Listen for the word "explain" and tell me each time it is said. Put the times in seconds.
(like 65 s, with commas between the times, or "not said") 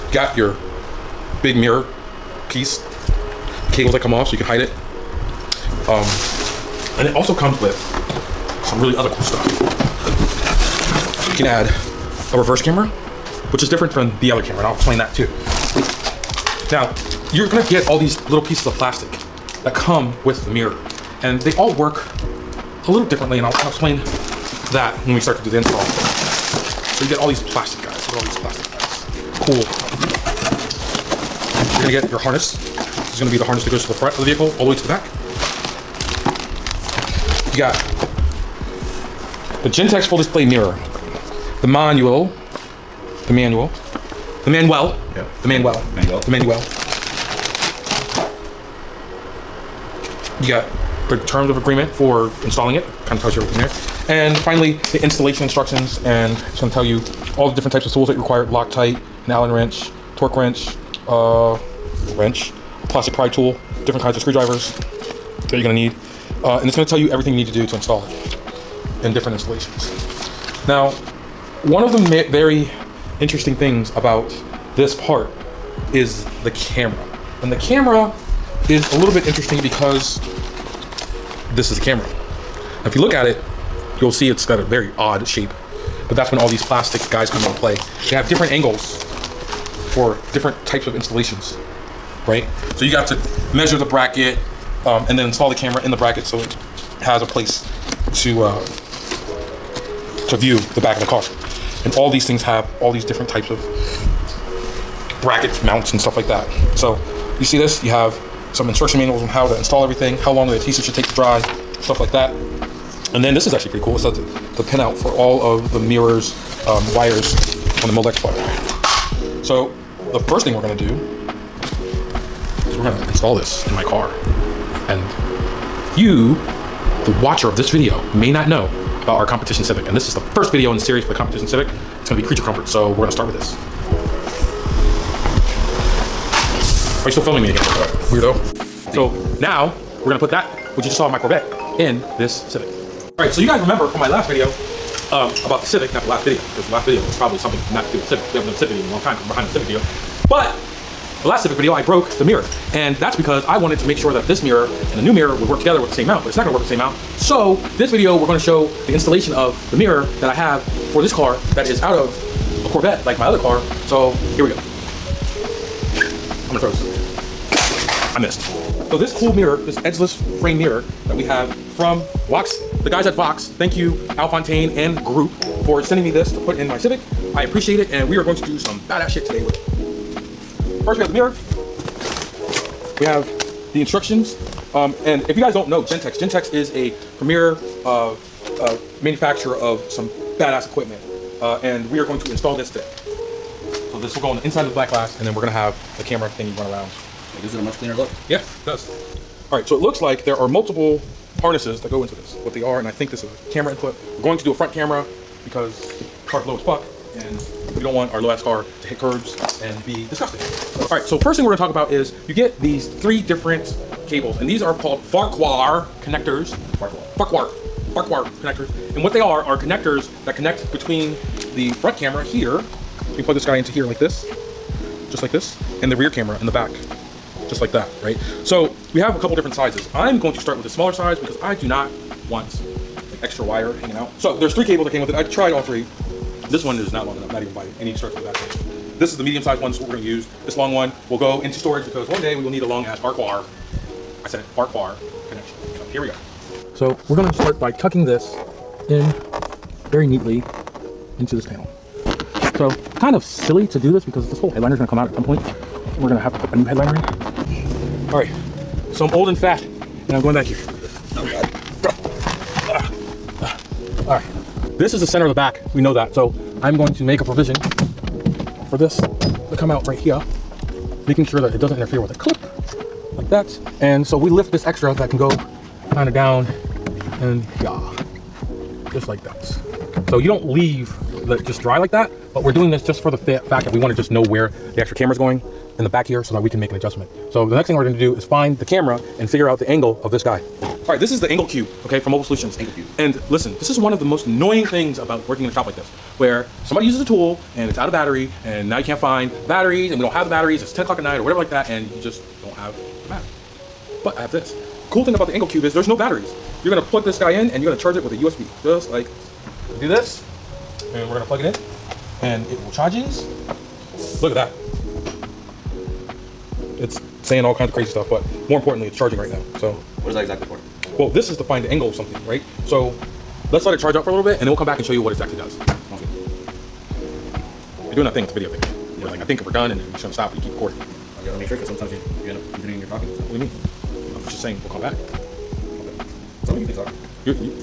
14 s, 23 s.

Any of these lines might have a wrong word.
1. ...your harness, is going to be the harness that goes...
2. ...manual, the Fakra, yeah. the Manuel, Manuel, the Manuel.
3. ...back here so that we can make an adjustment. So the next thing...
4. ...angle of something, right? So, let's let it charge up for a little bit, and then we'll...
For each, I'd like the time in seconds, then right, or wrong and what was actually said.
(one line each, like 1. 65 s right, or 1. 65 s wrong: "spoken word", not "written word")
1. 32 s right
2. 43 s wrong: "Manuel", not "Fakra"
3. 285 s right
4. 321 s right.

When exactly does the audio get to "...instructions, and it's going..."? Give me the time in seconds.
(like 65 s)
55 s.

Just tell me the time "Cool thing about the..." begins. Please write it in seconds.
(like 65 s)
304 s.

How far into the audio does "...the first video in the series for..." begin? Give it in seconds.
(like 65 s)
130 s.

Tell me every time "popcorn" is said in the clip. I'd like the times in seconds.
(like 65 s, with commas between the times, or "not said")
not said.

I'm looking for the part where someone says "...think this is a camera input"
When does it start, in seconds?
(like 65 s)
202 s.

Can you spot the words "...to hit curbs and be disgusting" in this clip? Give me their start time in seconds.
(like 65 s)
208 s.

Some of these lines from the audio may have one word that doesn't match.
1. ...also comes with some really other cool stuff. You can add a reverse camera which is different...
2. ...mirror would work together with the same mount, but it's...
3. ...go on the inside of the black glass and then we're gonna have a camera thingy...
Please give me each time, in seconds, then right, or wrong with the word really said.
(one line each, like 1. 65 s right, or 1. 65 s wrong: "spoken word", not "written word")
1. 7 s right
2. 155 s right
3. 194 s right.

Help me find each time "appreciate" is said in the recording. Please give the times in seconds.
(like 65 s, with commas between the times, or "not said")
177 s.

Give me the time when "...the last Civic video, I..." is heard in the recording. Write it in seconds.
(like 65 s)
151 s.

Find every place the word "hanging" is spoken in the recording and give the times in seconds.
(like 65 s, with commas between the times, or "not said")
233 s.